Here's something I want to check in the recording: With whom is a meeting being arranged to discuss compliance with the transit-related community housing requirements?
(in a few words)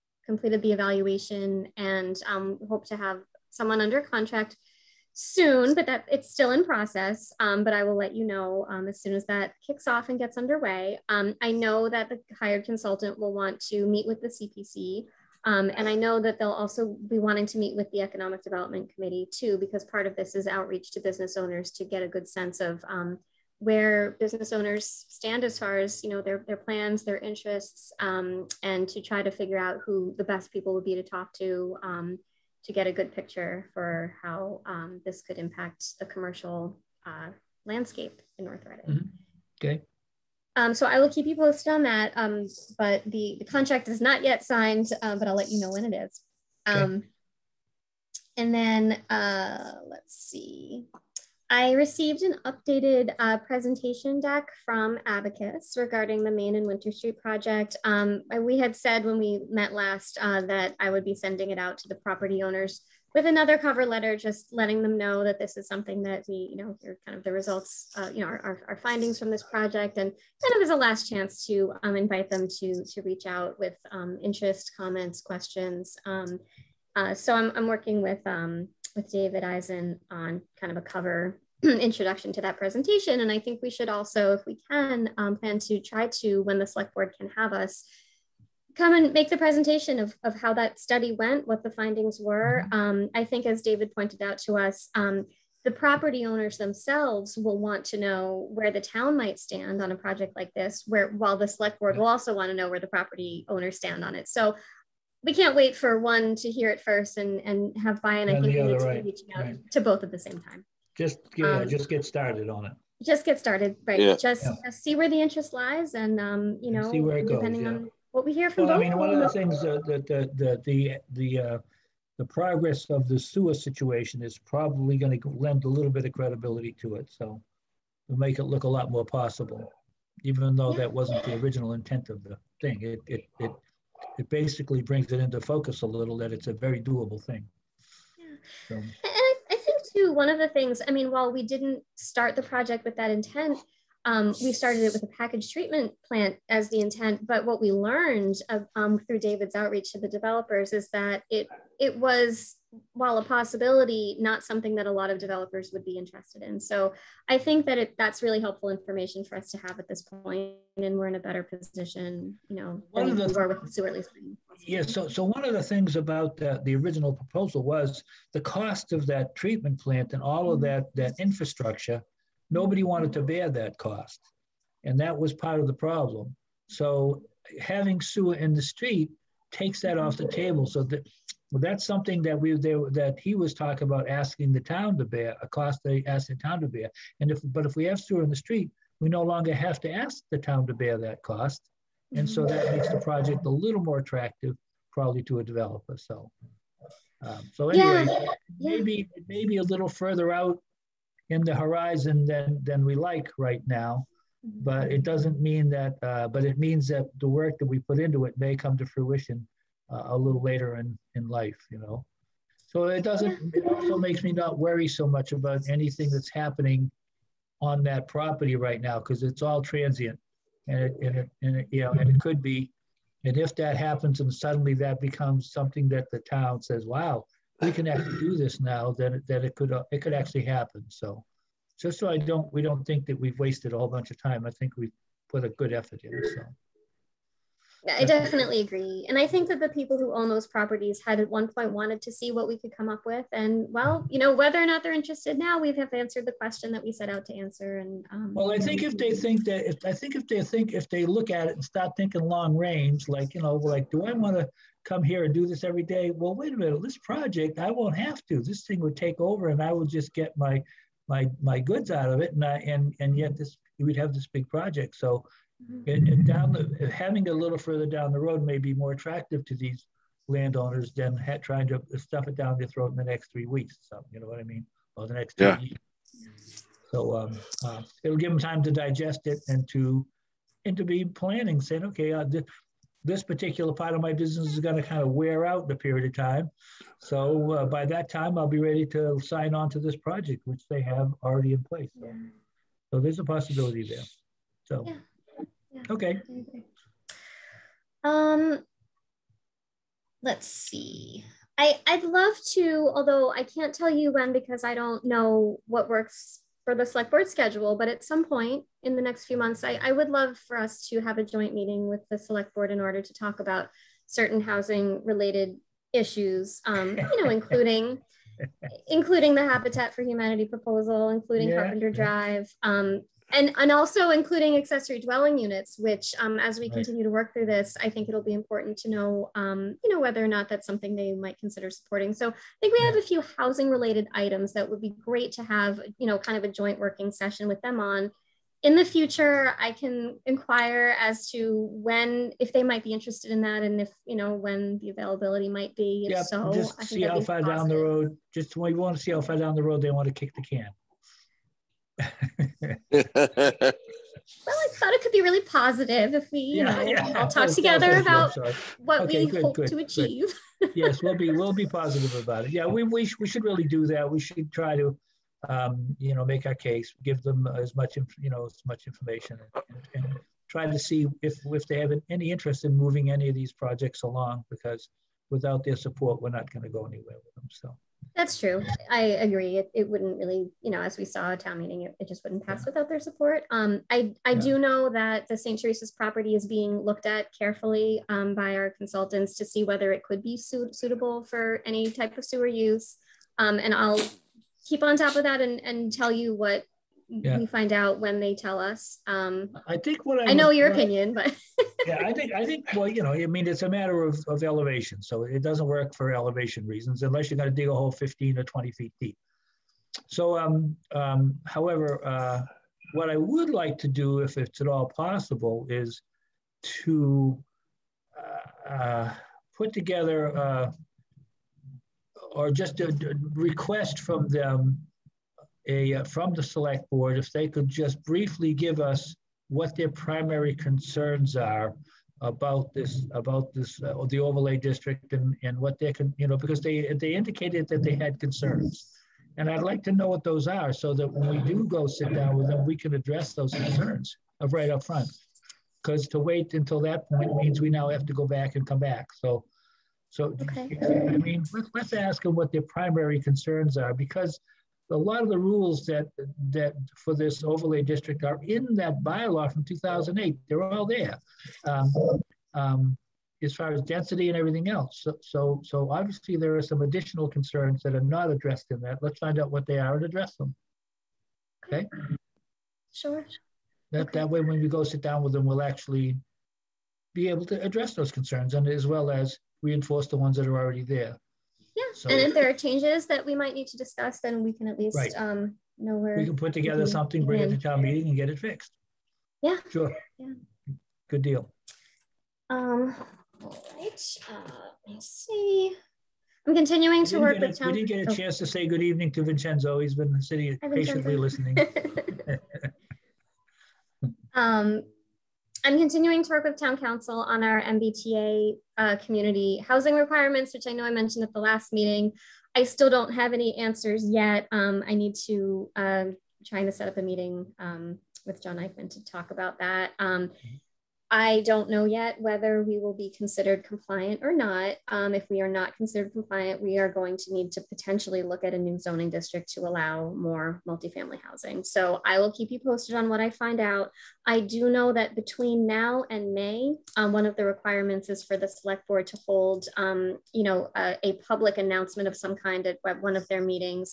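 John Eichman.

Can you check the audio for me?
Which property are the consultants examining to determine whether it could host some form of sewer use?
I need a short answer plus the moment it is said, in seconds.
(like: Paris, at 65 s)
St. Teresa's, at 385 s.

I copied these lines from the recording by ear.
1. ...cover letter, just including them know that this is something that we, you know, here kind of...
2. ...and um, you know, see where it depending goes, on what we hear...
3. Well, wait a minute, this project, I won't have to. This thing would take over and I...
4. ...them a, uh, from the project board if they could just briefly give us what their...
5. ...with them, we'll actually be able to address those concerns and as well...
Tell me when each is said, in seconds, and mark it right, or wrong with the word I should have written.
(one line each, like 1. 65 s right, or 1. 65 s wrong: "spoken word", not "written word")
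1. 63 s wrong: "letting", not "including"
2. 115 s right
3. 256 s right
4. 424 s wrong: "select", not "project"
5. 475 s right.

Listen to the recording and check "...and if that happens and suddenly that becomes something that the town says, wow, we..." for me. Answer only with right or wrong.
right.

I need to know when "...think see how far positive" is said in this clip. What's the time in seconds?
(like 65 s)
346 s.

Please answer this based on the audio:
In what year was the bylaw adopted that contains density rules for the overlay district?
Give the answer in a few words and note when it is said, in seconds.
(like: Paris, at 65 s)
2008, at 459 s.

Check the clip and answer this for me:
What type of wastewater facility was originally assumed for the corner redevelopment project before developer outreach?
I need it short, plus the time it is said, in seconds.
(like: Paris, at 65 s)
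Package treatment plant, at 145 s.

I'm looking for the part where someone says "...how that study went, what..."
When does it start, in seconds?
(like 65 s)
90 s.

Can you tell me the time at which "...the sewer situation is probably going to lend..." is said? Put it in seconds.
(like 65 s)
123 s.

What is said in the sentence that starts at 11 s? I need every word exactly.
Um, I know that the hired consultant will want to meet with the CPC.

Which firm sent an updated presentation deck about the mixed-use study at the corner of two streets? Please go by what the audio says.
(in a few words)
Abacus.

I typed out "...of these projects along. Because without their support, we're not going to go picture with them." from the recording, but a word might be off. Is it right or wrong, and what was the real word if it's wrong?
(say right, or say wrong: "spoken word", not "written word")
wrong: "anywhere", not "picture".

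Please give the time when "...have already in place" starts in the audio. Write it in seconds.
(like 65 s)
290 s.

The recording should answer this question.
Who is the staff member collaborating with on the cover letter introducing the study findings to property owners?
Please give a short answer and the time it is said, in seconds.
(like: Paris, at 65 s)
David Eisen, at 79 s.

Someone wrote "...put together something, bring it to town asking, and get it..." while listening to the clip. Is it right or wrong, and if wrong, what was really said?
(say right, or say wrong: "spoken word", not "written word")
wrong: "meeting", not "asking".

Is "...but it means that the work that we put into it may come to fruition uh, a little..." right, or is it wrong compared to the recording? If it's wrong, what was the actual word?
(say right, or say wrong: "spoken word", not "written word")
right.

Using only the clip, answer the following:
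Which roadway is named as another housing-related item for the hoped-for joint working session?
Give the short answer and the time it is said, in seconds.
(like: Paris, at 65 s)
Carpenter Drive, at 321 s.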